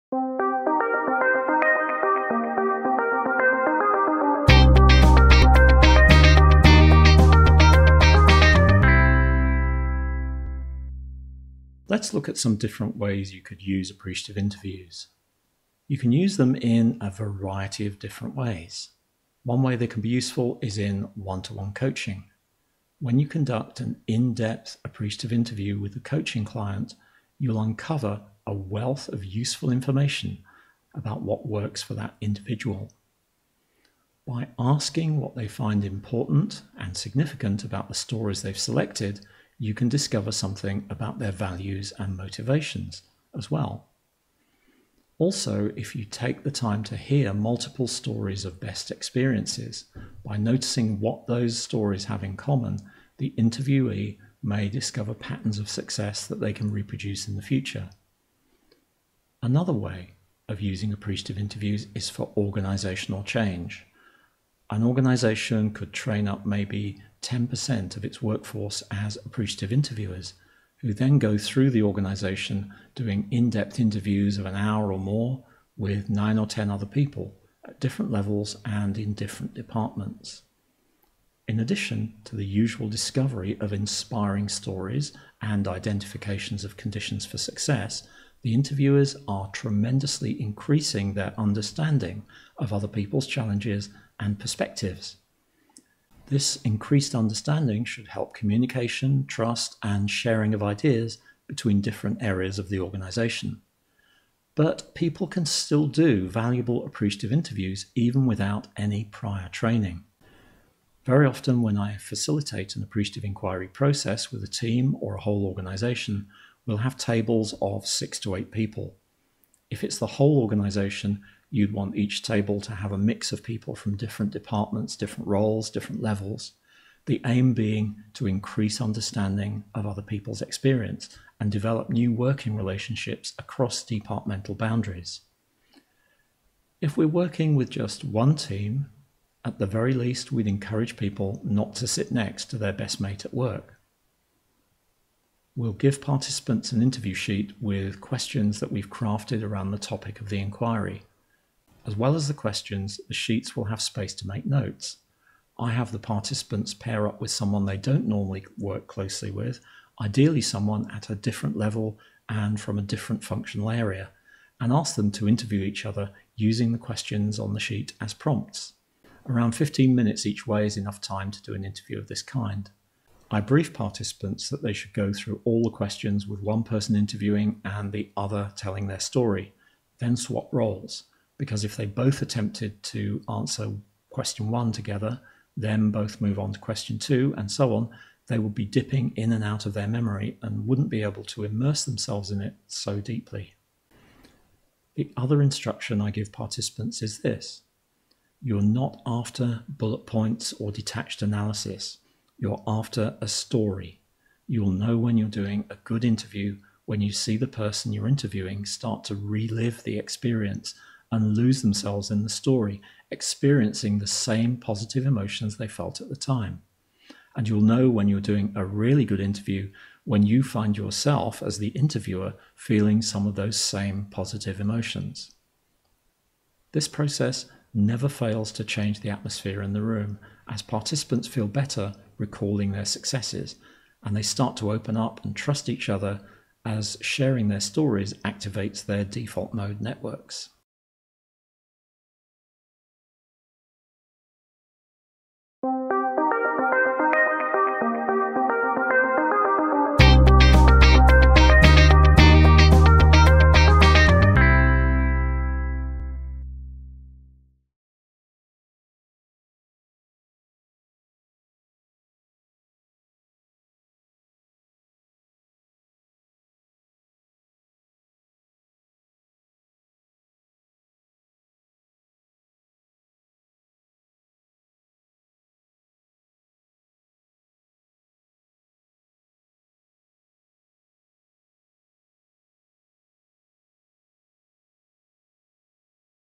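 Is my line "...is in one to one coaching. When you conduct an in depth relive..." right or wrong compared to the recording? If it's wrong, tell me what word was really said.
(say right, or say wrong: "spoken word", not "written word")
wrong: "appreciative", not "relive".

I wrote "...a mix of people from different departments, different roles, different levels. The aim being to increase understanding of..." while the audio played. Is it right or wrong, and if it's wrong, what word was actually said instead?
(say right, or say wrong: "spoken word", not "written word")
right.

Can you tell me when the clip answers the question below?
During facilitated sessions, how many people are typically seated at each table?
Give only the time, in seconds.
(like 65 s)
117 s.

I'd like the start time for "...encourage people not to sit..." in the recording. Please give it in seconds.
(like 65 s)
140 s.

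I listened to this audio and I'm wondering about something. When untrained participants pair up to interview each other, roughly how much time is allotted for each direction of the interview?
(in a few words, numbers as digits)
15 minutes.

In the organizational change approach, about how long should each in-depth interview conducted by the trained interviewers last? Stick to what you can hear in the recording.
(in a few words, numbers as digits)
an hour or more.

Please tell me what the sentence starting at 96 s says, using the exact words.
This increased understanding should help communication, trust, and sharing of ideas between different areas of the organization.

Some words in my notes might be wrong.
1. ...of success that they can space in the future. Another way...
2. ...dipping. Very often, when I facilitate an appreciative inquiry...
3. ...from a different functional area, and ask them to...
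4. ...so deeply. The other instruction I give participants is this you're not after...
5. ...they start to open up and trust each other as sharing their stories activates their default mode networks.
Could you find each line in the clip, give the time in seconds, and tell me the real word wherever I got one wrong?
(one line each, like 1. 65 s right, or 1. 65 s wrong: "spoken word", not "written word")
1. 55 s wrong: "reproduce", not "space"
2. 109 s wrong: "training", not "dipping"
3. 162 s right
4. 192 s right
5. 234 s right.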